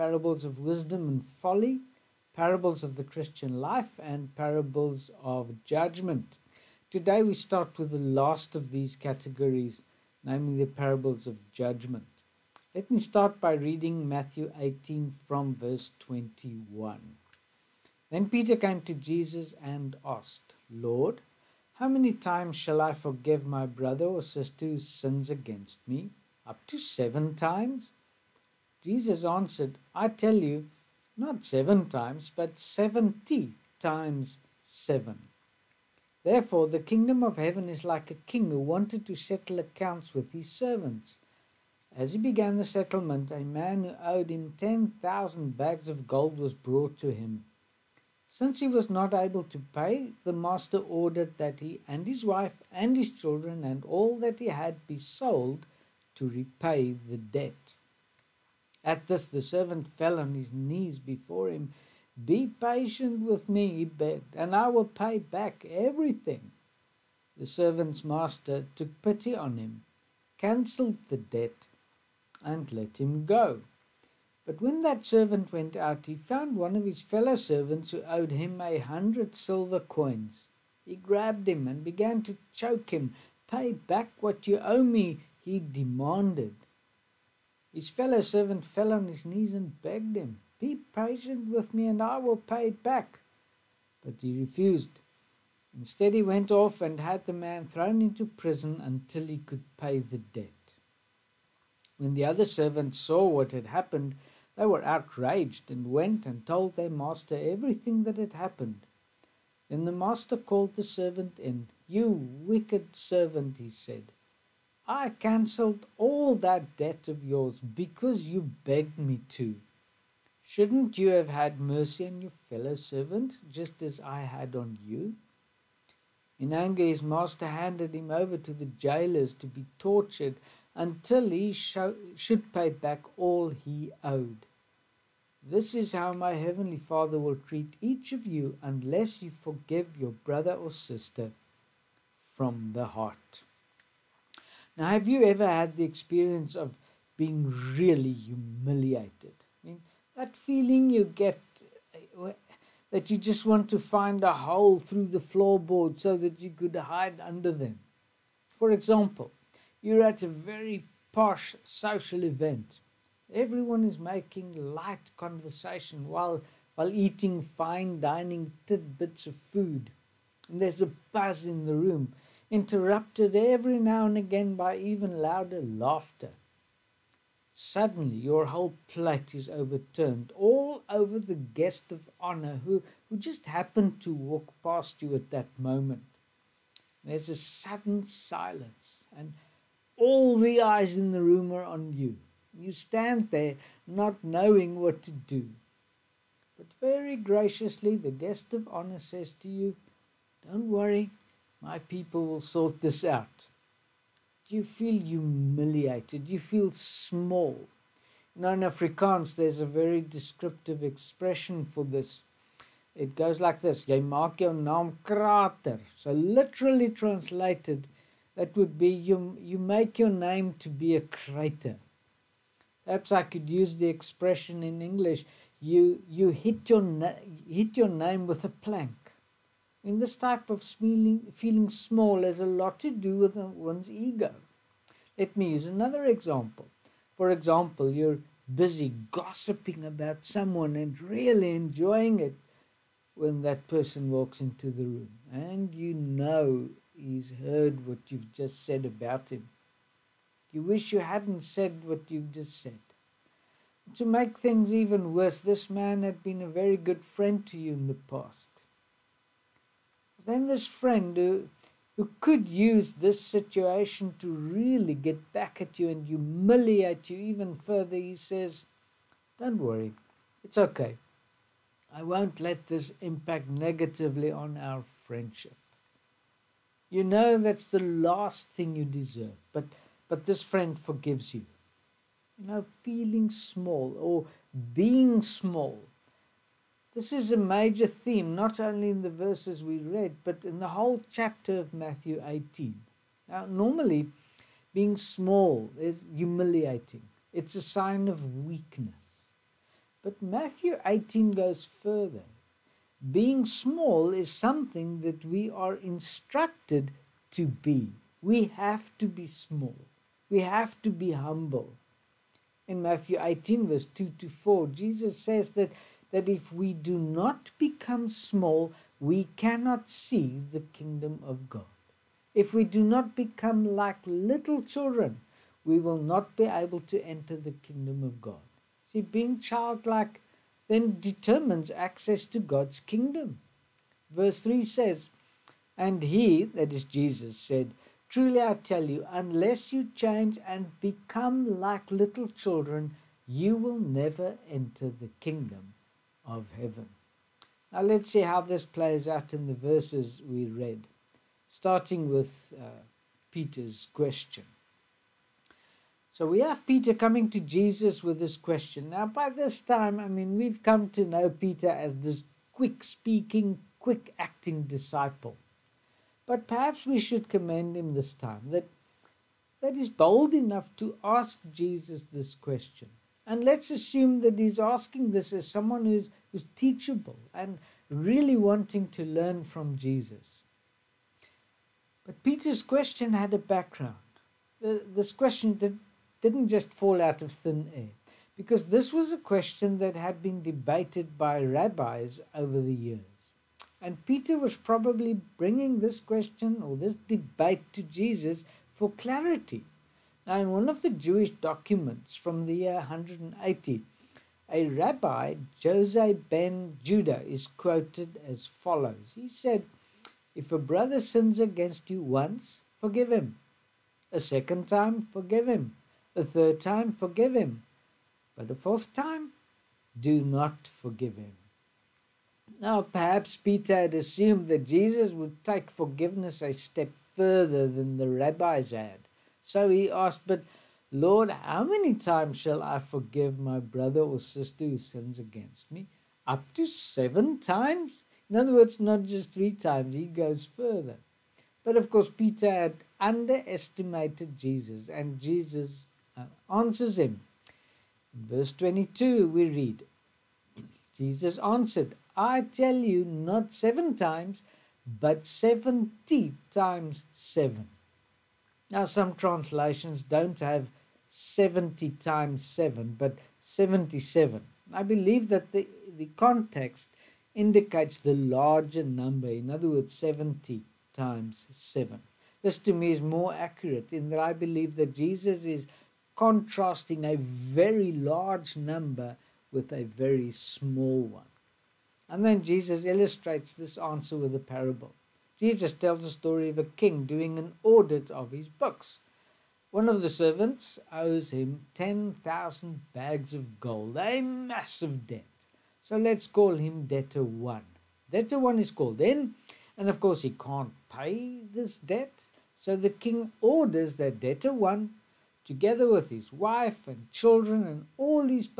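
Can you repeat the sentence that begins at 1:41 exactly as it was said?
When the other servants saw what had happened, they were outraged and went and told their master everything that had happened.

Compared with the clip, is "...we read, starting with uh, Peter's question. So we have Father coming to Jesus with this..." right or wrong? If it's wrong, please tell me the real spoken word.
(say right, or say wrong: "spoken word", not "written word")
wrong: "Peter", not "Father".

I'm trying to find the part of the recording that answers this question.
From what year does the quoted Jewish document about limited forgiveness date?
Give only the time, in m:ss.
6:42.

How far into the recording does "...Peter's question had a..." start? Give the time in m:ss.
6:22.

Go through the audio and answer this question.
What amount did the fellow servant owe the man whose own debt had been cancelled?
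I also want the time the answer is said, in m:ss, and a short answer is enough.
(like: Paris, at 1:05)
100 silver coins, at 1:18.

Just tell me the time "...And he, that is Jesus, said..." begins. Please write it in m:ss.
5:35.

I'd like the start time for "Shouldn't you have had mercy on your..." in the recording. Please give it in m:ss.
2:00.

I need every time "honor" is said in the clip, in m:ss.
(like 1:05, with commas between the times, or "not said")
3:02, 3:18.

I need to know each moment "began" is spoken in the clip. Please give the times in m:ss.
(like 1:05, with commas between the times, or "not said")
0:42, 1:21.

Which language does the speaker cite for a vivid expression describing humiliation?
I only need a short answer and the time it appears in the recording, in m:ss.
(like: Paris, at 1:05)
Afrikaans, at 3:28.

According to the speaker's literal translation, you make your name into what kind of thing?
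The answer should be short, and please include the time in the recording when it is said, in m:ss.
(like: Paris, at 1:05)
A crater, at 3:40.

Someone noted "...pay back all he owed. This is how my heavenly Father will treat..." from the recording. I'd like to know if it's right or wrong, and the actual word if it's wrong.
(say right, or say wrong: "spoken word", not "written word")
right.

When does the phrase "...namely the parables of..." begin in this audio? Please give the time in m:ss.
0:10.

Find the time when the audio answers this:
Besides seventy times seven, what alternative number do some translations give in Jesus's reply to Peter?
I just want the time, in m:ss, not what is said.
7:43.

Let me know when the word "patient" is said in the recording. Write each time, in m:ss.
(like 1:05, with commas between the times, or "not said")
1:02, 1:30.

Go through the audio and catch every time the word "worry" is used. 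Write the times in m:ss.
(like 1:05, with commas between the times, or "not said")
3:20, 4:29.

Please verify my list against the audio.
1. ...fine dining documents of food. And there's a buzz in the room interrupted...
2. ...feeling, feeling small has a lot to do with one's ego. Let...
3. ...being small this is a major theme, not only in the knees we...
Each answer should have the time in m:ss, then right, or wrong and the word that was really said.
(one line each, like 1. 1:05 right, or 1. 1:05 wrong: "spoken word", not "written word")
1. 2:47 wrong: "tidbits", not "documents"
2. 3:50 right
3. 4:44 wrong: "verses", not "knees".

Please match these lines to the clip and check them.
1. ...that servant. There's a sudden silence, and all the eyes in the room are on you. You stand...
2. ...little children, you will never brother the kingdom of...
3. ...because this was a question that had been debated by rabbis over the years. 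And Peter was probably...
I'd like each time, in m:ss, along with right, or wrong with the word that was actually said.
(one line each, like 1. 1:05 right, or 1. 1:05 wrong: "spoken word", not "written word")
1. 3:05 wrong: "moment", not "servant"
2. 5:41 wrong: "enter", not "brother"
3. 6:28 right.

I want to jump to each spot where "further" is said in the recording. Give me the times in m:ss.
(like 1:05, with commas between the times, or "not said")
4:27, 5:01, 7:07, 7:20.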